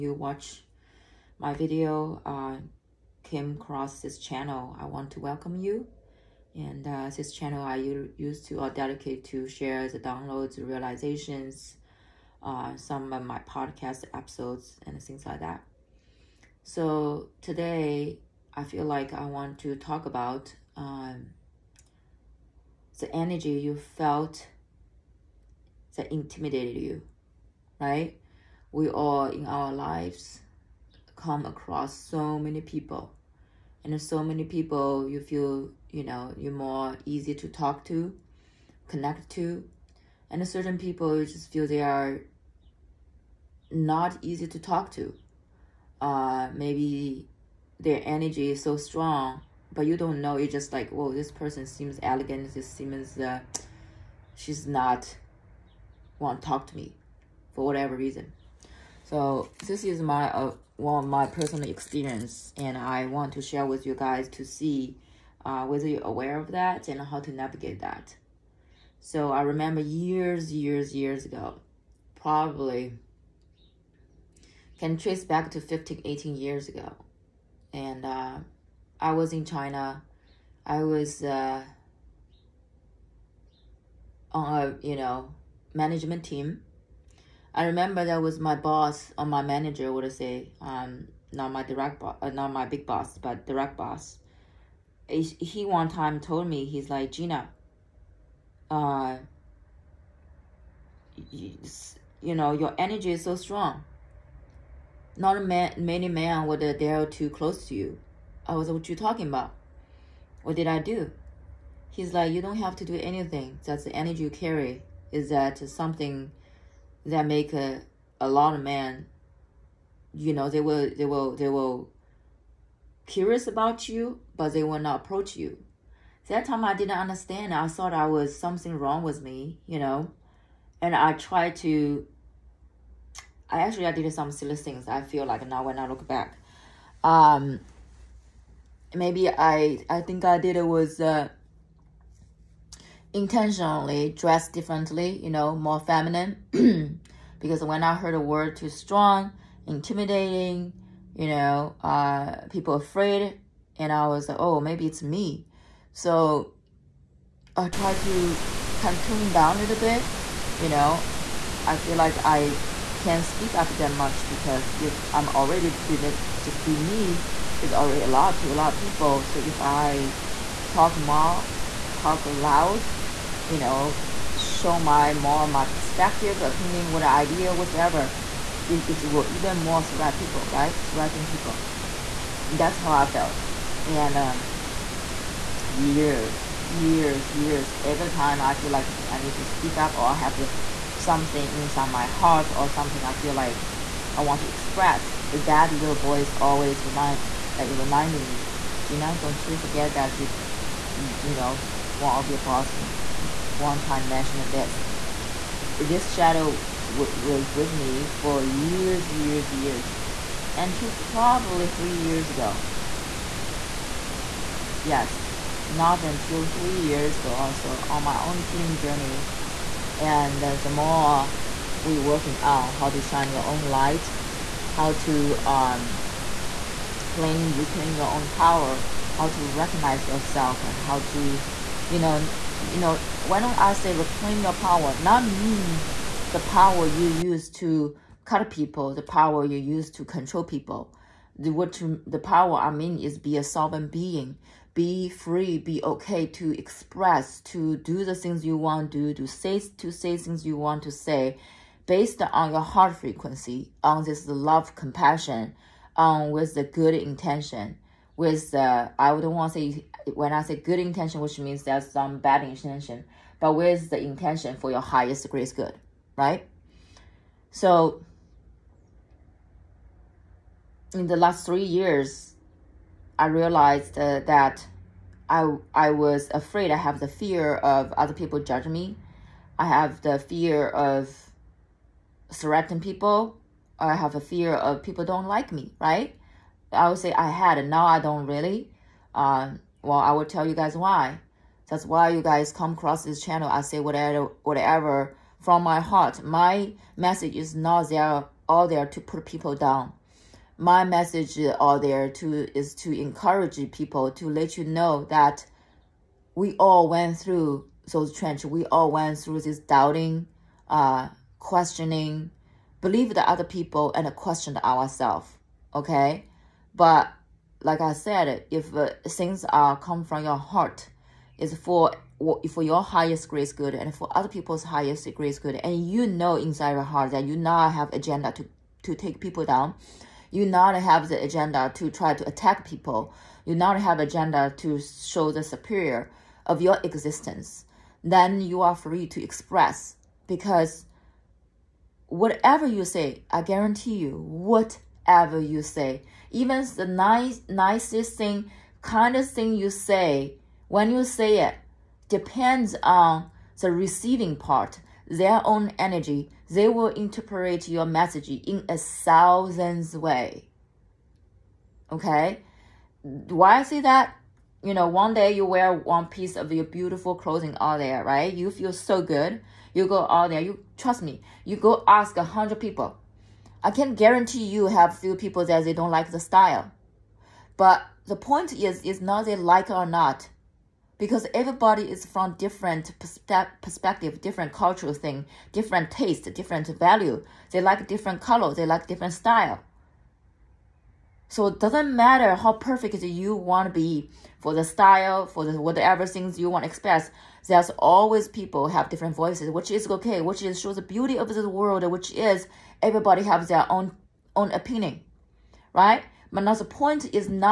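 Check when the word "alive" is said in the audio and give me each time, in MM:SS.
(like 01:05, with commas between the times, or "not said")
not said.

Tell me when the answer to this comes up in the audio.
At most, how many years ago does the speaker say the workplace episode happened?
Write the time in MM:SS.
01:16.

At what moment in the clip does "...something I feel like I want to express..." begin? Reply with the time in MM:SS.
03:12.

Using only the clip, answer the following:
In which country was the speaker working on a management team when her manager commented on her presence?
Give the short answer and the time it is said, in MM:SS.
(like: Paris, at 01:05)
China, at 01:19.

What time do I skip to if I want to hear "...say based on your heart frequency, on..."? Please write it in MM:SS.
04:10.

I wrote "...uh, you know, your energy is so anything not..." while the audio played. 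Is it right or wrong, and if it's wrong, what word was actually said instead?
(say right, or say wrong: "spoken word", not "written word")
wrong: "strong", not "anything".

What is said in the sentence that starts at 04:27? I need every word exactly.
So in the last three years, I realized uh, that I I was afraid.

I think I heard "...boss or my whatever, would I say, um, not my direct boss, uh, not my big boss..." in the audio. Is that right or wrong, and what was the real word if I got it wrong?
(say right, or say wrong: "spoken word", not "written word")
wrong: "manager", not "whatever".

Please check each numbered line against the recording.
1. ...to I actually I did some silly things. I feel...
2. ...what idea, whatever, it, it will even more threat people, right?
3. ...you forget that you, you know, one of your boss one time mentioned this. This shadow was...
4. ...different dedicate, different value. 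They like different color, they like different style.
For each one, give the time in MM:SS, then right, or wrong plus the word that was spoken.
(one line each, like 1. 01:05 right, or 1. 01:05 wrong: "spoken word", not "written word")
1. 02:11 right
2. 02:56 right
3. 03:19 right
4. 06:25 wrong: "taste", not "dedicate".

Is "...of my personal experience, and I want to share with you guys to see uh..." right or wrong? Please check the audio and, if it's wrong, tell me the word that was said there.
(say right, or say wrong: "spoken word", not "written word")
right.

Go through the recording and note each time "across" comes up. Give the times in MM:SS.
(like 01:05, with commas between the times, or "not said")
00:03, 00:31, 04:52.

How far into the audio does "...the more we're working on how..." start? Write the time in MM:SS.
03:40.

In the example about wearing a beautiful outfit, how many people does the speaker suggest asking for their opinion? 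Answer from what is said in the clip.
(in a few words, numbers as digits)
100.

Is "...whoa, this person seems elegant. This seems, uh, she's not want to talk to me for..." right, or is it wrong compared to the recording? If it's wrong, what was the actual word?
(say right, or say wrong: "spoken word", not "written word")
right.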